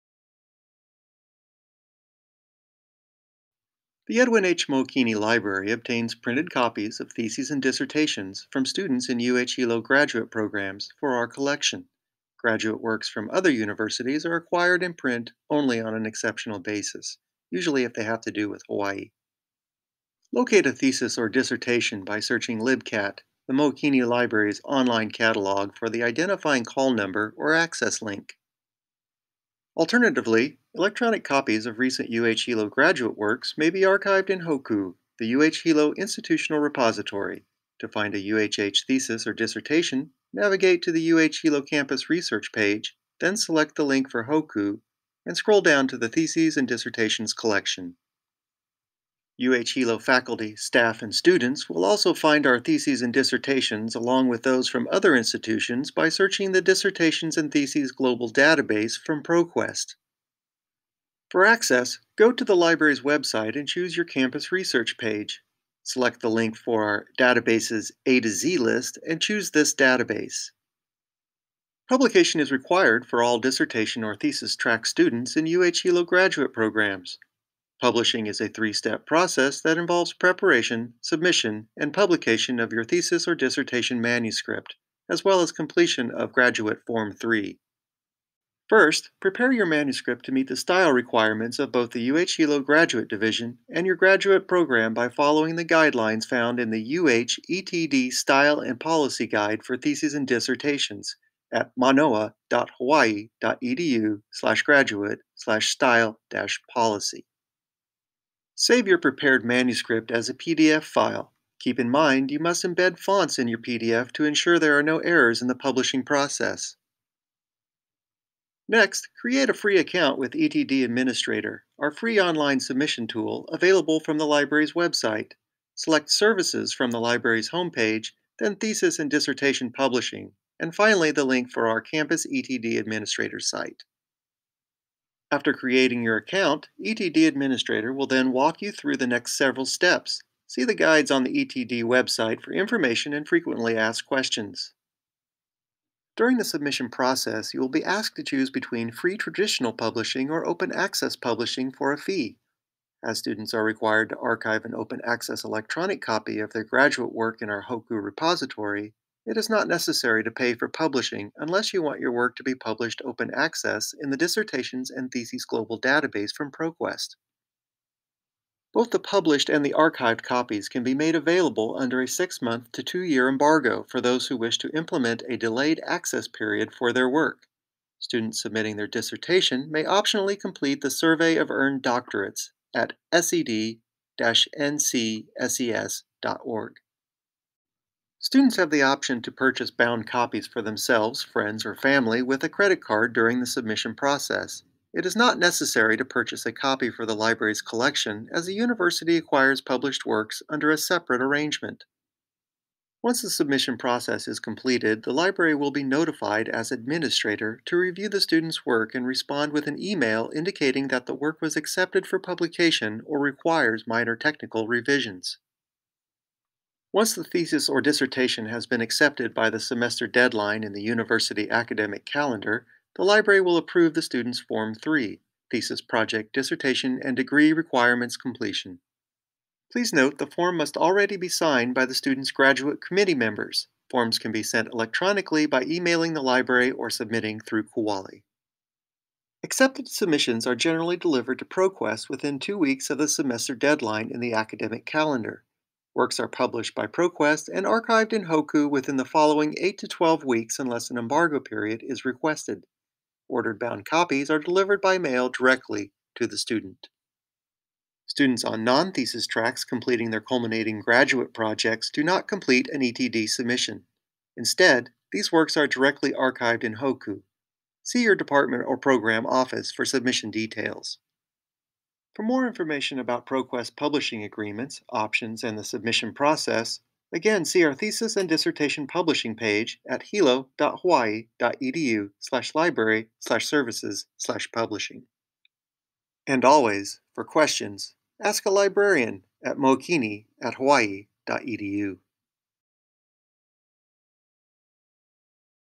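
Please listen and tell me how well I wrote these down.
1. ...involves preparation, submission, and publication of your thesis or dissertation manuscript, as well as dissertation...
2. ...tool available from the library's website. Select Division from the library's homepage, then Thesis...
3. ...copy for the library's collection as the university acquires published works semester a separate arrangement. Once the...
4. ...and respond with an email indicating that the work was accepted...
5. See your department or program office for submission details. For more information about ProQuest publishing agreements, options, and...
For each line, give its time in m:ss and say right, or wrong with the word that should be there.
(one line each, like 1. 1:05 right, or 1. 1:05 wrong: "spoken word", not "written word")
1. 1:19 wrong: "completion", not "dissertation"
2. 2:03 wrong: "Services", not "Division"
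3. 3:16 wrong: "under", not "semester"
4. 3:28 right
5. 4:27 right.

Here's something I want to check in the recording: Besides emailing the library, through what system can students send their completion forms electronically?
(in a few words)
Kuali.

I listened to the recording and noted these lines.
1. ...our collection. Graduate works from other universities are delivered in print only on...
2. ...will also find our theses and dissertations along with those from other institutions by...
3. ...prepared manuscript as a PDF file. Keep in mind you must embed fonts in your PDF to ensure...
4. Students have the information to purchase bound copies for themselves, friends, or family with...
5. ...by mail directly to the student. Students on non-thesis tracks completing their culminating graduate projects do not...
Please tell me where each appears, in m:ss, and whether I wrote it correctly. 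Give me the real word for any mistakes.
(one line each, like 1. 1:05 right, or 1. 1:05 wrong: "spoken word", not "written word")
1. 0:11 wrong: "acquired", not "delivered"
2. 0:51 right
3. 1:48 right
4. 3:08 wrong: "option", not "information"
5. 4:14 right.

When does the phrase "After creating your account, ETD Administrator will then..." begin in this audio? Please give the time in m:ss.
2:15.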